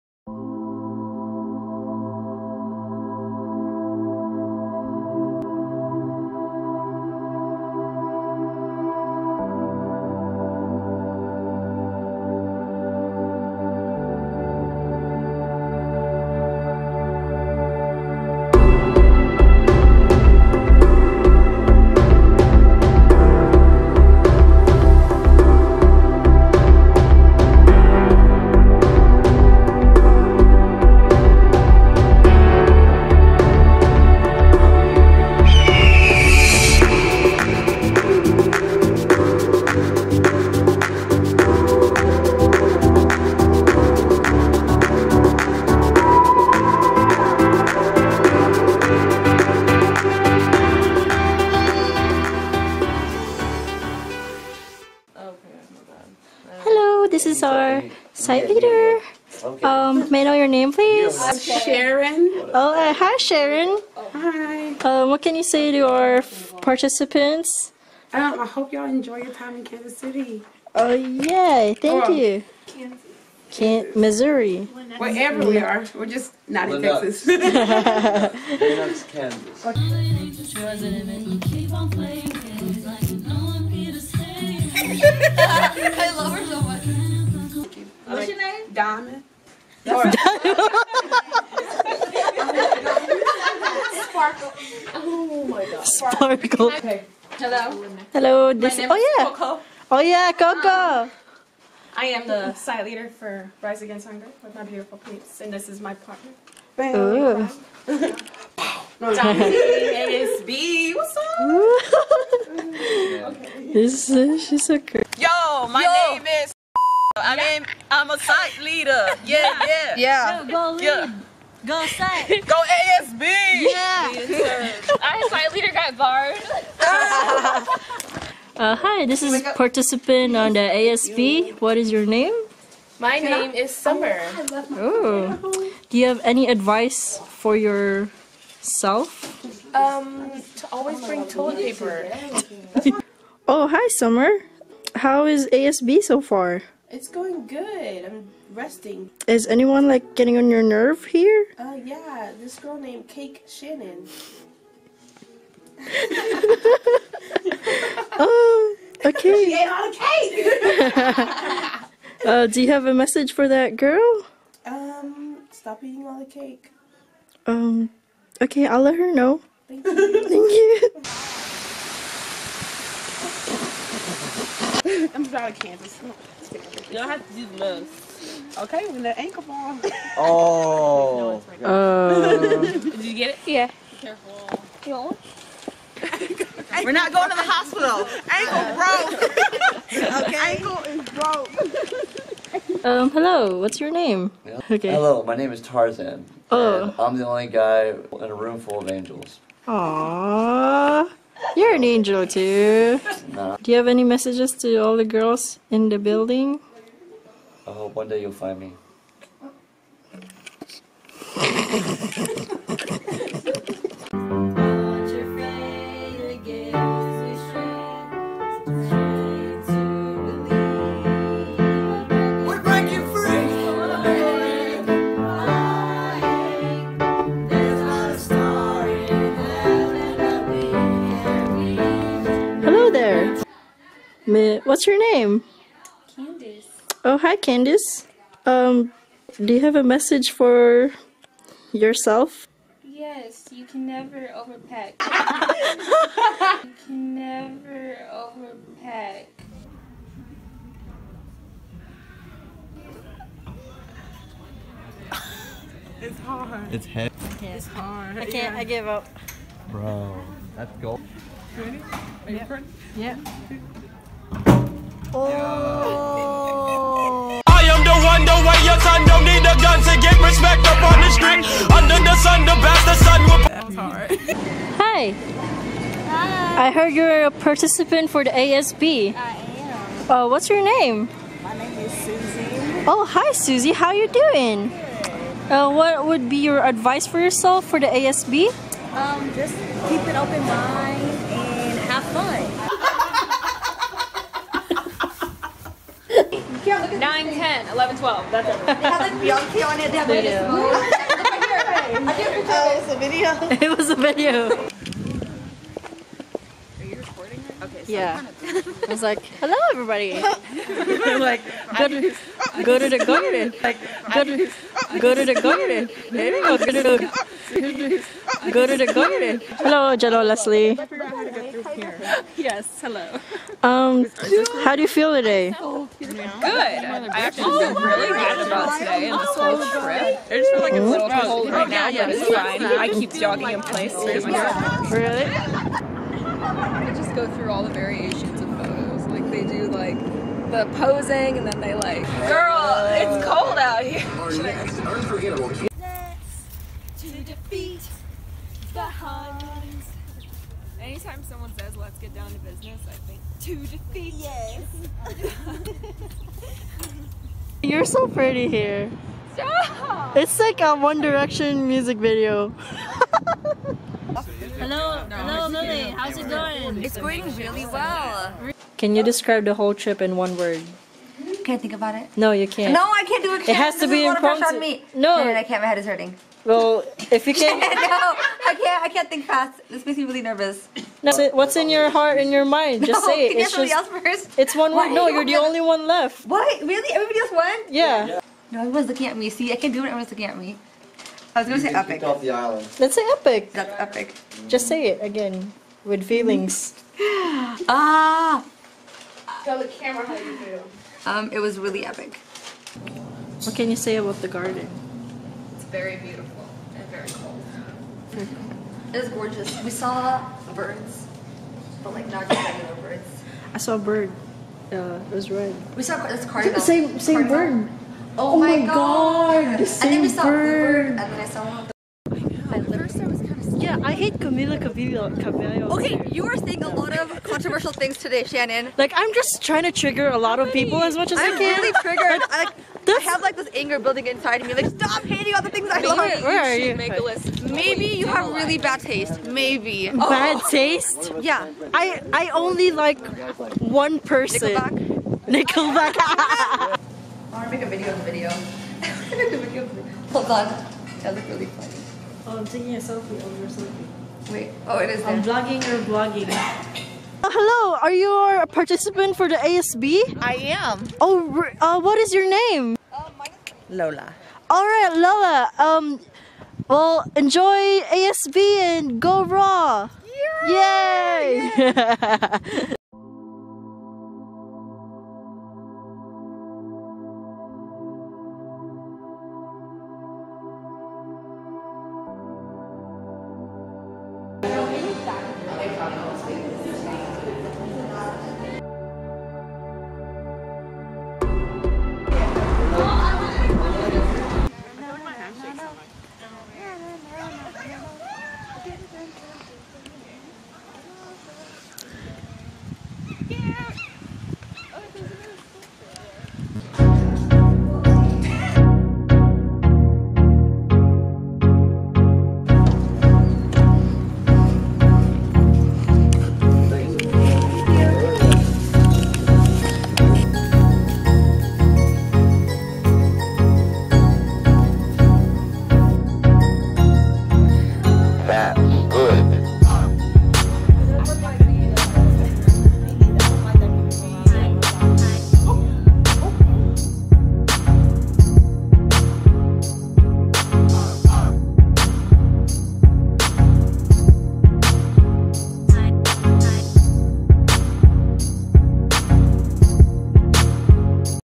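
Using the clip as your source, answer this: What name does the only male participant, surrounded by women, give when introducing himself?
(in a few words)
Tarzan.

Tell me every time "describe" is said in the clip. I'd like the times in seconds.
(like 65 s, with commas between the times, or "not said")
369 s.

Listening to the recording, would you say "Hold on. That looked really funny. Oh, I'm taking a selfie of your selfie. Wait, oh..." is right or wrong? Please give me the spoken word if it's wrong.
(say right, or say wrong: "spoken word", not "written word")
right.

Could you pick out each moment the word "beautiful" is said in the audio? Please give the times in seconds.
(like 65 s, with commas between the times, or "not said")
104 s, 405 s.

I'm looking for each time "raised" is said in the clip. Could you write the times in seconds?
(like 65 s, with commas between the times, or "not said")
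not said.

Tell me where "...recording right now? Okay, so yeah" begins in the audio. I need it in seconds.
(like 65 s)
306 s.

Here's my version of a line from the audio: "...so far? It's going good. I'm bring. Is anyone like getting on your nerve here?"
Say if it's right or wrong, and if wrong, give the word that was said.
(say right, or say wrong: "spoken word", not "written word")
wrong: "resting", not "bring".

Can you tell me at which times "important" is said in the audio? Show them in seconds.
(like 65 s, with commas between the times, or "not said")
374 s.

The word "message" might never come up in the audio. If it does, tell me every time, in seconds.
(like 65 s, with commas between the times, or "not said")
162 s, 204 s, 239 s.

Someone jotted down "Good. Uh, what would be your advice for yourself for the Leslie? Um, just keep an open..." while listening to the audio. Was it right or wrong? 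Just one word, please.
wrong.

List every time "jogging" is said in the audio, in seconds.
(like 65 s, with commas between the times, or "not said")
333 s.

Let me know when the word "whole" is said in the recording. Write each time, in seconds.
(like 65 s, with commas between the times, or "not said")
329 s, 369 s.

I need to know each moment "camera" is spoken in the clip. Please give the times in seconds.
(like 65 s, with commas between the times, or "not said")
399 s.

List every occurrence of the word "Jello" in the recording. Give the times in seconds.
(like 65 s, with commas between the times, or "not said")
319 s.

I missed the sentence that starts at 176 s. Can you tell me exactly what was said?
Y'all have to do the most.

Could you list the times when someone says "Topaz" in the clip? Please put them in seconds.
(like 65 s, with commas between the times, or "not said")
not said.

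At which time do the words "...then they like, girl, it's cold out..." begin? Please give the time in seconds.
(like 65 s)
341 s.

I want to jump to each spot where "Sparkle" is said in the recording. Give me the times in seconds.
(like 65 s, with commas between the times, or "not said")
89 s, 95 s.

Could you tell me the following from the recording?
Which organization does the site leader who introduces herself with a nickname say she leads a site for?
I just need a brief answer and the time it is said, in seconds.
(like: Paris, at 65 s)
Rise Against Hunger, at 103 s.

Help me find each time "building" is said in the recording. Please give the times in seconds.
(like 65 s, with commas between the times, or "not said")
205 s, 433 s.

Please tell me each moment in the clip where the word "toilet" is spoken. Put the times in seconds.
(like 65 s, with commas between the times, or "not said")
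141 s.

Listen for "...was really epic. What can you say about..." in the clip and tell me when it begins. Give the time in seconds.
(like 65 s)
401 s.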